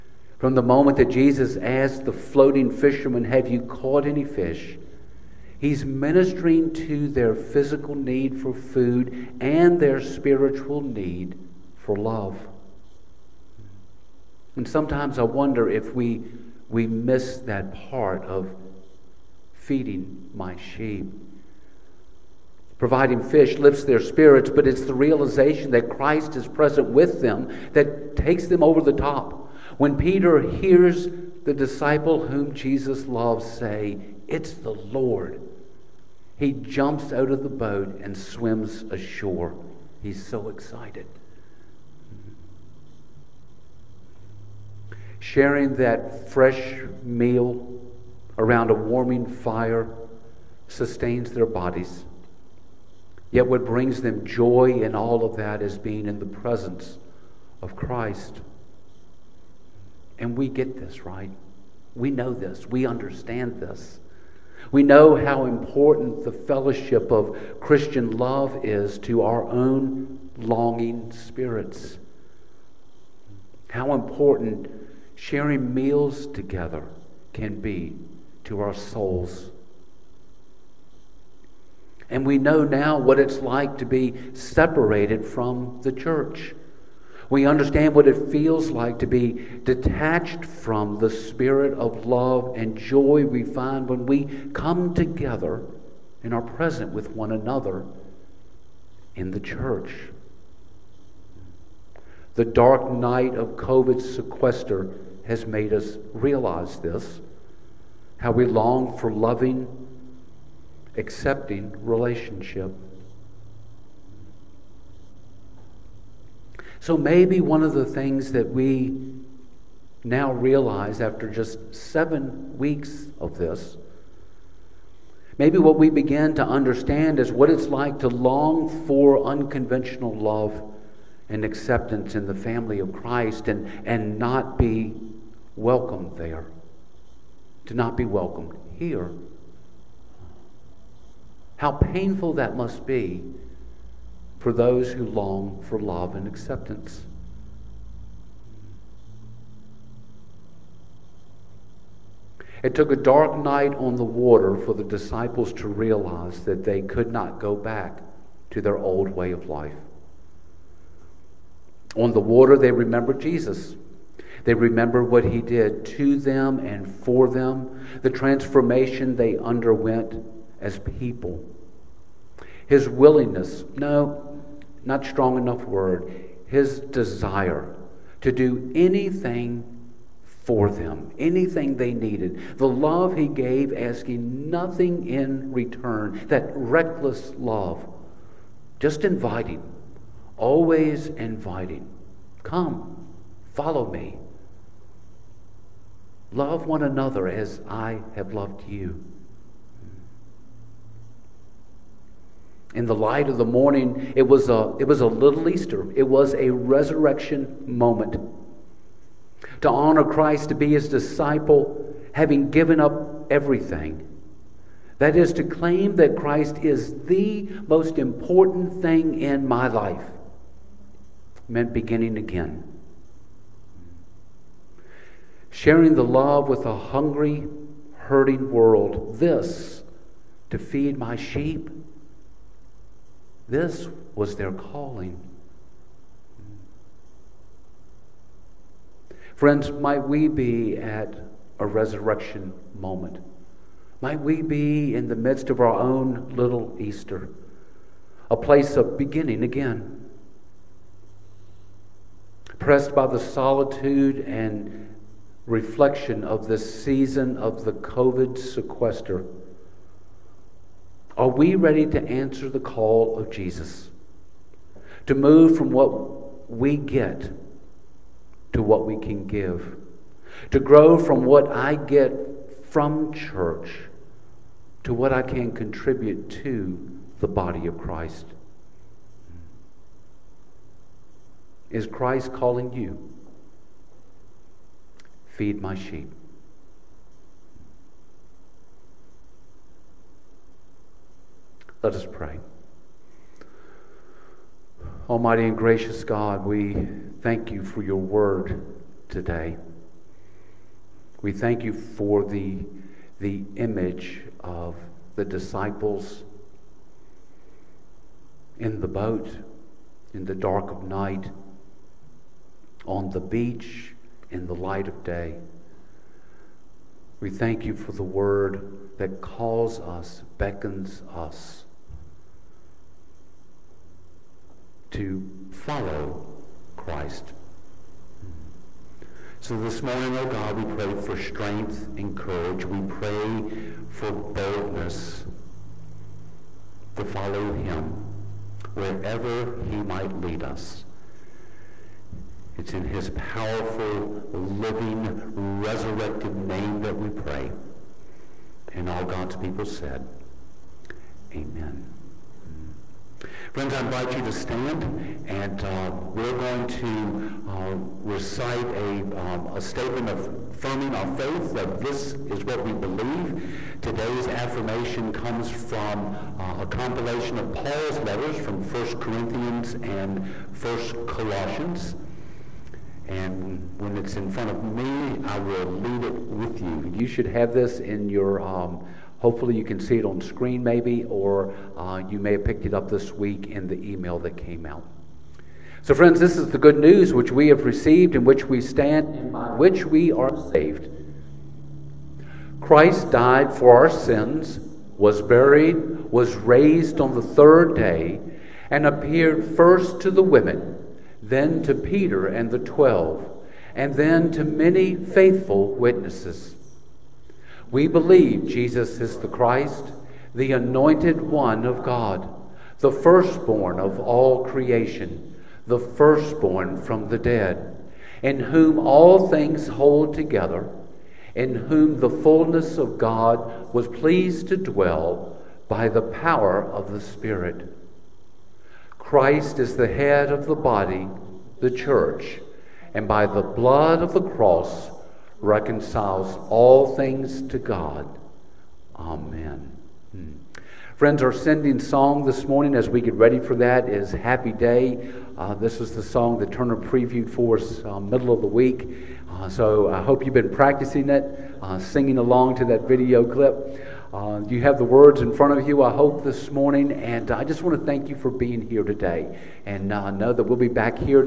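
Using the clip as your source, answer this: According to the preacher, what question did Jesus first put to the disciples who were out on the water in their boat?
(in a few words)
Have you caught any fish?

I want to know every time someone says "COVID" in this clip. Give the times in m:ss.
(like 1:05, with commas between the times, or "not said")
1:43, 4:17.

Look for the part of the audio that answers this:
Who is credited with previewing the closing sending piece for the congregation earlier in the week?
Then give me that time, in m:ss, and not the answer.
7:26.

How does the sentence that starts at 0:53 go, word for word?
Yet, what brings them joy in all of that is being in the presence of Christ.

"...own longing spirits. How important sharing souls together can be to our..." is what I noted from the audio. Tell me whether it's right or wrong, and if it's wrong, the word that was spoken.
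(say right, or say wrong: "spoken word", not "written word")
wrong: "meals", not "souls".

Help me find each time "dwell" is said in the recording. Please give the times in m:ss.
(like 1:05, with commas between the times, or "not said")
7:04.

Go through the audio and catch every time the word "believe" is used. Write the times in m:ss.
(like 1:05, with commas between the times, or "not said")
6:02, 6:47.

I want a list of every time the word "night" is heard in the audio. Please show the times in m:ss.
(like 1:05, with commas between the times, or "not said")
1:42, 2:33, 5:10.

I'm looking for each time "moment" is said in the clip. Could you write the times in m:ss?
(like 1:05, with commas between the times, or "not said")
0:00, 3:27, 4:02.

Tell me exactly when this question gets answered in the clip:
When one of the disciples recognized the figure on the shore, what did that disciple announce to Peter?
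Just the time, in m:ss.
0:34.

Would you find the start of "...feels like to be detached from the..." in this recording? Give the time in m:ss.
1:28.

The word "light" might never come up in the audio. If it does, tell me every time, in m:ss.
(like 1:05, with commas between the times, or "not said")
3:22, 5:14.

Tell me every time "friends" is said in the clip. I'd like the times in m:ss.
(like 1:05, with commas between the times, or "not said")
3:59, 5:53, 6:25, 7:20.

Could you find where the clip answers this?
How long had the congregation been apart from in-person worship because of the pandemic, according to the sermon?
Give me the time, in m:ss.
2:01.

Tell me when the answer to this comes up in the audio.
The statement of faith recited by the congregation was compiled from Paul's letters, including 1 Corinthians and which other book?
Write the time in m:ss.
6:10.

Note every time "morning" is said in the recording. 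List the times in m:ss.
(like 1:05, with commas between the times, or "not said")
3:23, 5:29, 7:22, 7:36.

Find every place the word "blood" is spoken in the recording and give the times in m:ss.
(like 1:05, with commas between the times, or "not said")
7:13.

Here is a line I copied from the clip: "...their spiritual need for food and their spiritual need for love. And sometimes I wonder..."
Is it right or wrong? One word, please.
wrong.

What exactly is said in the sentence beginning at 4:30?
To grow from what I get from church to what I can contribute to the body of Christ.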